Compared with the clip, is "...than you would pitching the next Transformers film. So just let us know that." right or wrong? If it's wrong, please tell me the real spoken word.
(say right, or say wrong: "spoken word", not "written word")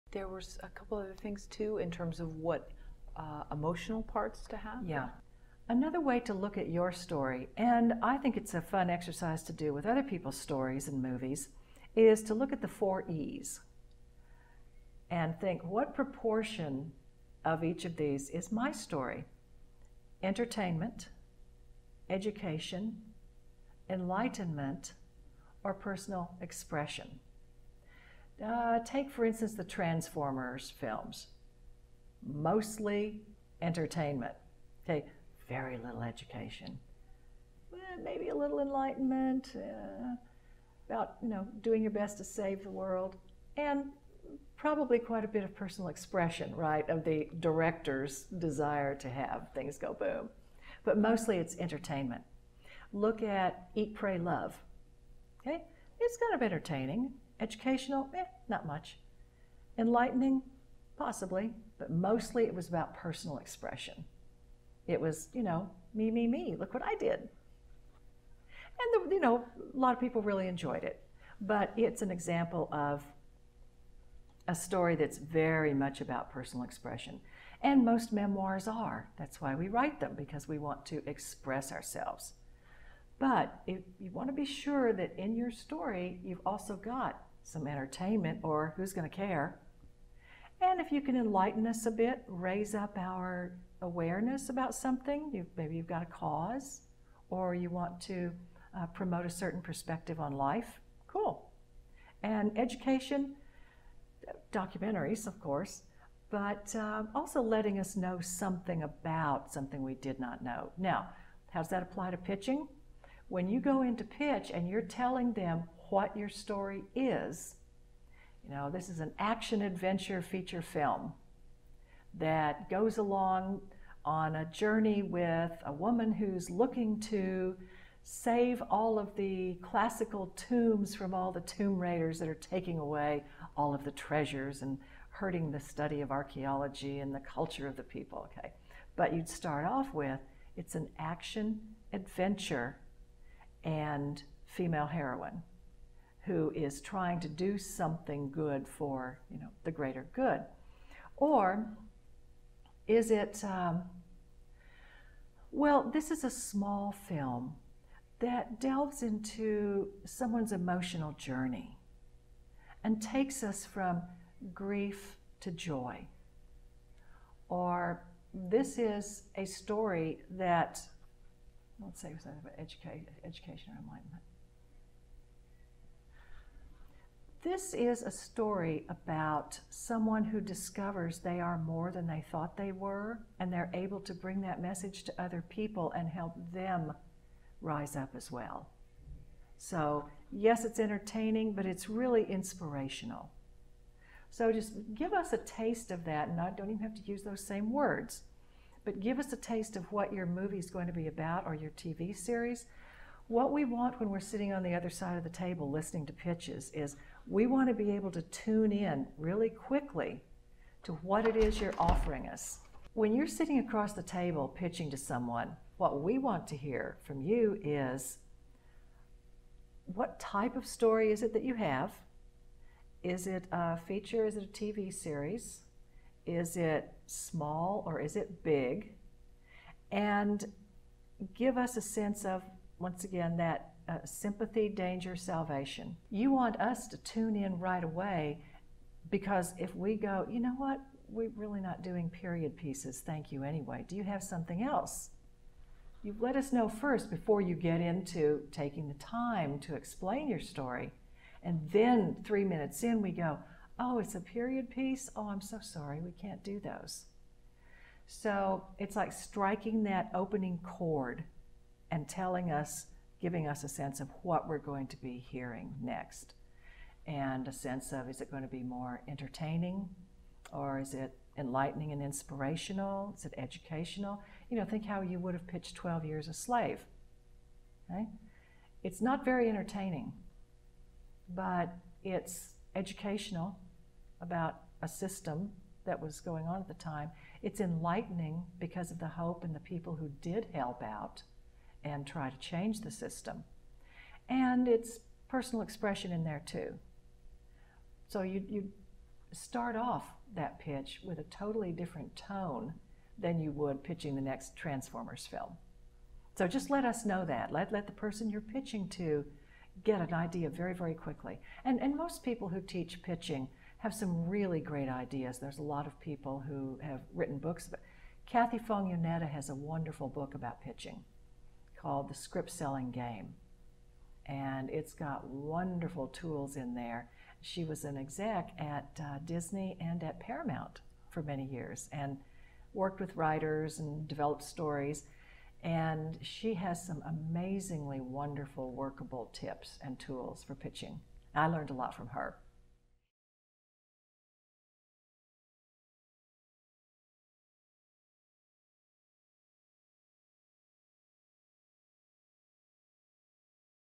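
right.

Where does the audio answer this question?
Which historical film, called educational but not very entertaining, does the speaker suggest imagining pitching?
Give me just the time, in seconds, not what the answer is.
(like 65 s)
275 s.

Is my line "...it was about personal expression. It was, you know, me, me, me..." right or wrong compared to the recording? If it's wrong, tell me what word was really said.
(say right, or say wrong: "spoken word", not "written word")
right.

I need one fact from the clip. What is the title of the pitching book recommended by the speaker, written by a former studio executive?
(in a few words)
The Script Selling Game.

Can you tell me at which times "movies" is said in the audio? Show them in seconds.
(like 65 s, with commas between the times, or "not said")
11 s, 200 s.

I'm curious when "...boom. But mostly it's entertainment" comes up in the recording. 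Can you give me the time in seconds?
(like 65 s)
49 s.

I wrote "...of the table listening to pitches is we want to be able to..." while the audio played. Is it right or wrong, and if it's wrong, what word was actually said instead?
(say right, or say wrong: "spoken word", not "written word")
right.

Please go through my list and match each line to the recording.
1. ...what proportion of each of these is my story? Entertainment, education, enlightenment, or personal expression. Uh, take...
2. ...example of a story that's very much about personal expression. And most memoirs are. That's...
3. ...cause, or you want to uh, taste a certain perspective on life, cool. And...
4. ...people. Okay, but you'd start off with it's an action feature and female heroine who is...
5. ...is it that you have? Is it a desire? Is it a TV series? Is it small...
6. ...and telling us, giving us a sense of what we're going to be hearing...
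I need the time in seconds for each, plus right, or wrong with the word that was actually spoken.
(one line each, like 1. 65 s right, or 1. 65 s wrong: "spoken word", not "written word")
1. 15 s right
2. 72 s right
3. 96 s wrong: "promote", not "taste"
4. 137 s wrong: "adventure", not "feature"
5. 221 s wrong: "feature", not "desire"
6. 261 s right.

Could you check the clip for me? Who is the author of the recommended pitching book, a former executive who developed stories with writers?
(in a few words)
Kathie Fong Yoneda.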